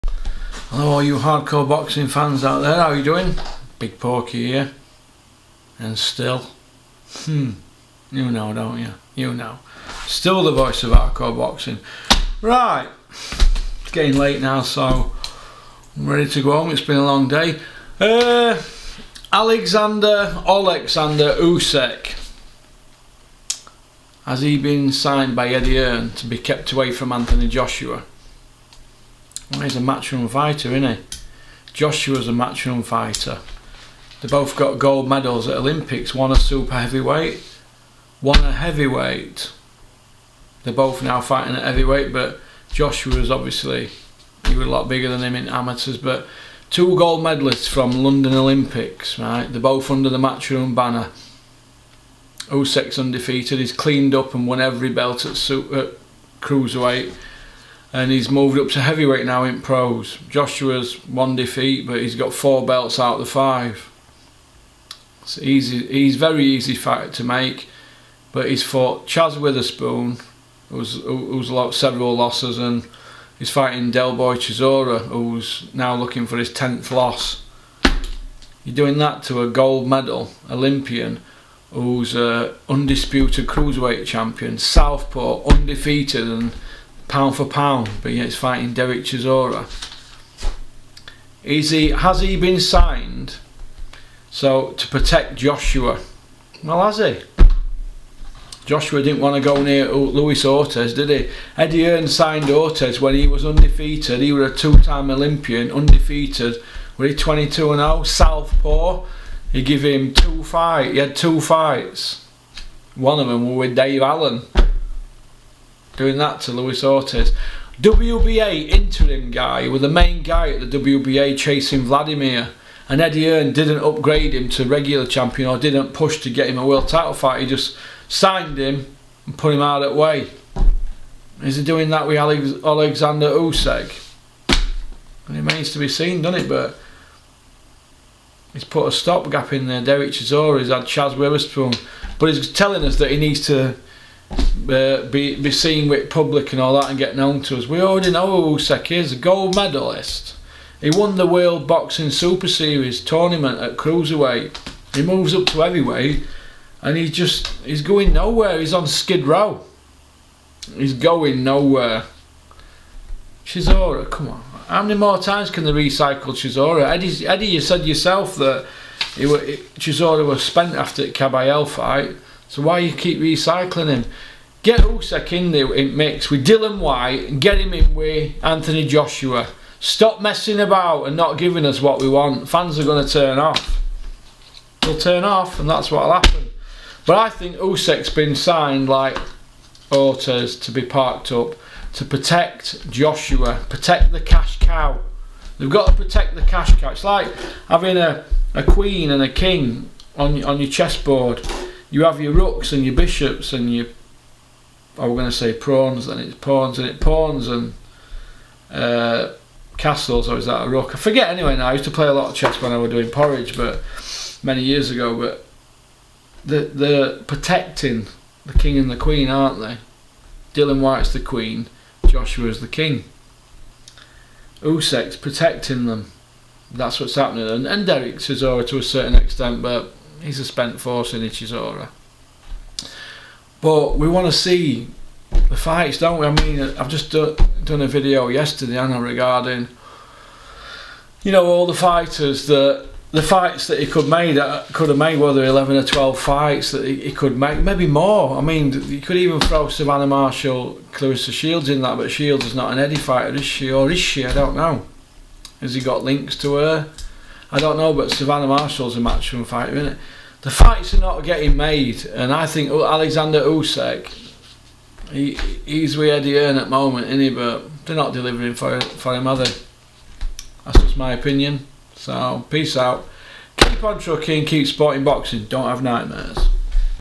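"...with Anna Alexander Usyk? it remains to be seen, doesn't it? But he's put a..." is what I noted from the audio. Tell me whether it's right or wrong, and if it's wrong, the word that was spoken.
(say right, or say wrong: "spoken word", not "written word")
wrong: "Alex", not "Anna".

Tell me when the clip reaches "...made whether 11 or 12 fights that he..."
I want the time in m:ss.
4:04.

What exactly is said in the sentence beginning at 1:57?
WBA interim guy, with the main guy at the WBA chasing Vladimir.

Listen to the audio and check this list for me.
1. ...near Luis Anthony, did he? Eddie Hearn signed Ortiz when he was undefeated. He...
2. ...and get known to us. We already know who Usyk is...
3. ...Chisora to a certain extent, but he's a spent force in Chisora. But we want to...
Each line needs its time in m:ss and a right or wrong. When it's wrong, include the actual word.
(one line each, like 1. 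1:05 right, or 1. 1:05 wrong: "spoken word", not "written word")
1. 1:39 wrong: "Ortiz", not "Anthony"
2. 2:26 right
3. 3:48 right.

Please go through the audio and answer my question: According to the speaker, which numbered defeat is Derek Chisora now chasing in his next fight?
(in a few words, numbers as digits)
10th.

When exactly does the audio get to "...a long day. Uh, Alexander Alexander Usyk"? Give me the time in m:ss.
0:16.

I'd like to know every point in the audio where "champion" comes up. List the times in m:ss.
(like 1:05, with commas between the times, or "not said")
1:24, 2:05.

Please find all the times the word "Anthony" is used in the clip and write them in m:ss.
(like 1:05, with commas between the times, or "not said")
0:27, 2:58.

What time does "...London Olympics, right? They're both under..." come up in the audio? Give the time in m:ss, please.
0:47.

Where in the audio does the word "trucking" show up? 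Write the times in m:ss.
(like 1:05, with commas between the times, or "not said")
4:33.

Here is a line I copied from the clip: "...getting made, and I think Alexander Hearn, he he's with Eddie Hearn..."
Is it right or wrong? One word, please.
wrong.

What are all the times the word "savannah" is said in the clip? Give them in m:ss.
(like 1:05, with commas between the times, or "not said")
4:09, 4:18.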